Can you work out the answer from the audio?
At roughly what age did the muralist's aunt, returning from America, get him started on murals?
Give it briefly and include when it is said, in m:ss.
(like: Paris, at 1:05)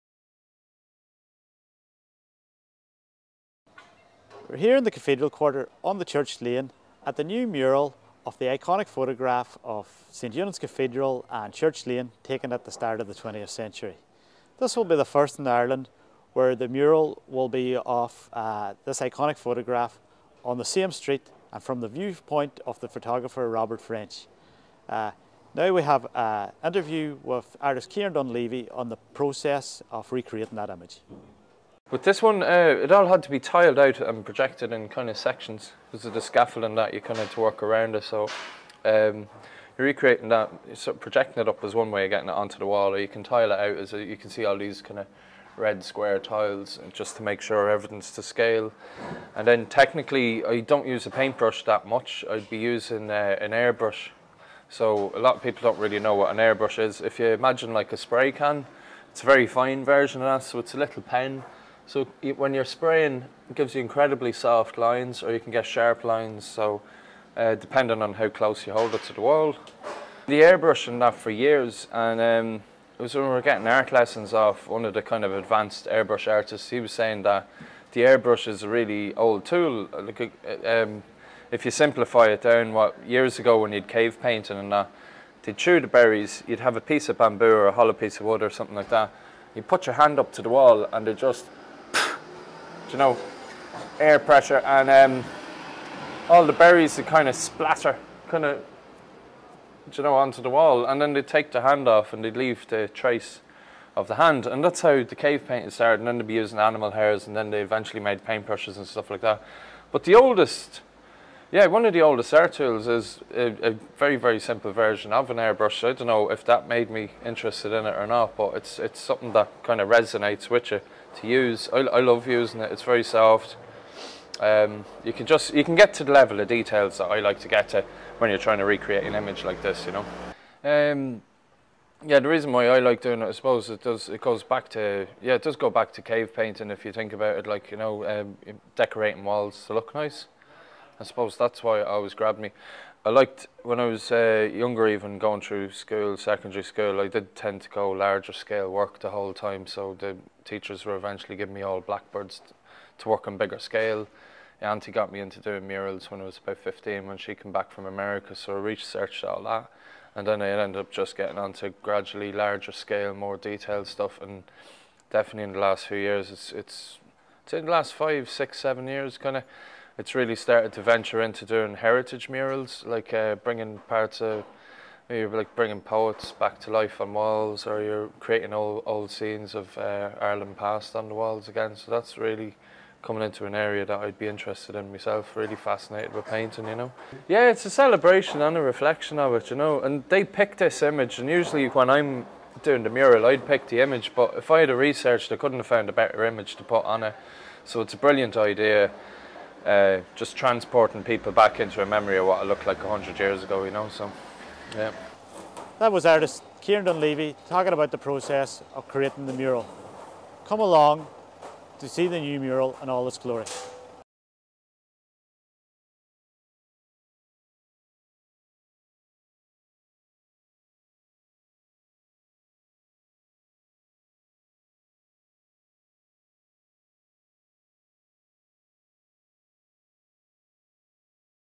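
15, at 2:36.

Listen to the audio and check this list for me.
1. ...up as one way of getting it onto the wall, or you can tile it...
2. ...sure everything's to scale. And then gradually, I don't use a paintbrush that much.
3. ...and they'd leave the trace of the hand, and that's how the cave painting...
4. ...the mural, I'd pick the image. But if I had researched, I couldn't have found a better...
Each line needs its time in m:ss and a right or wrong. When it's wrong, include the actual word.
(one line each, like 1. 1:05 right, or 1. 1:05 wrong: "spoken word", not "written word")
1. 0:41 right
2. 0:47 wrong: "technically", not "gradually"
3. 1:42 right
4. 3:12 right.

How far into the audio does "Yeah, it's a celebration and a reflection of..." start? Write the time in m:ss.
3:07.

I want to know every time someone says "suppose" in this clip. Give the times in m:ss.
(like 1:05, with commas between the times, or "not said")
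2:13, 2:21.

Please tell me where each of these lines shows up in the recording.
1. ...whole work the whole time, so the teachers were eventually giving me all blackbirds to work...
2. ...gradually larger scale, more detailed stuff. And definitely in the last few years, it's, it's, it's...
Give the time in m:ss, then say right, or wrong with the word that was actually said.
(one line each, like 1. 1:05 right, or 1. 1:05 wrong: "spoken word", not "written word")
1. 2:28 wrong: "scale", not "whole"
2. 2:41 right.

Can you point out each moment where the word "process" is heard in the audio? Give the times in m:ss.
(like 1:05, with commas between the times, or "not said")
0:29, 3:27.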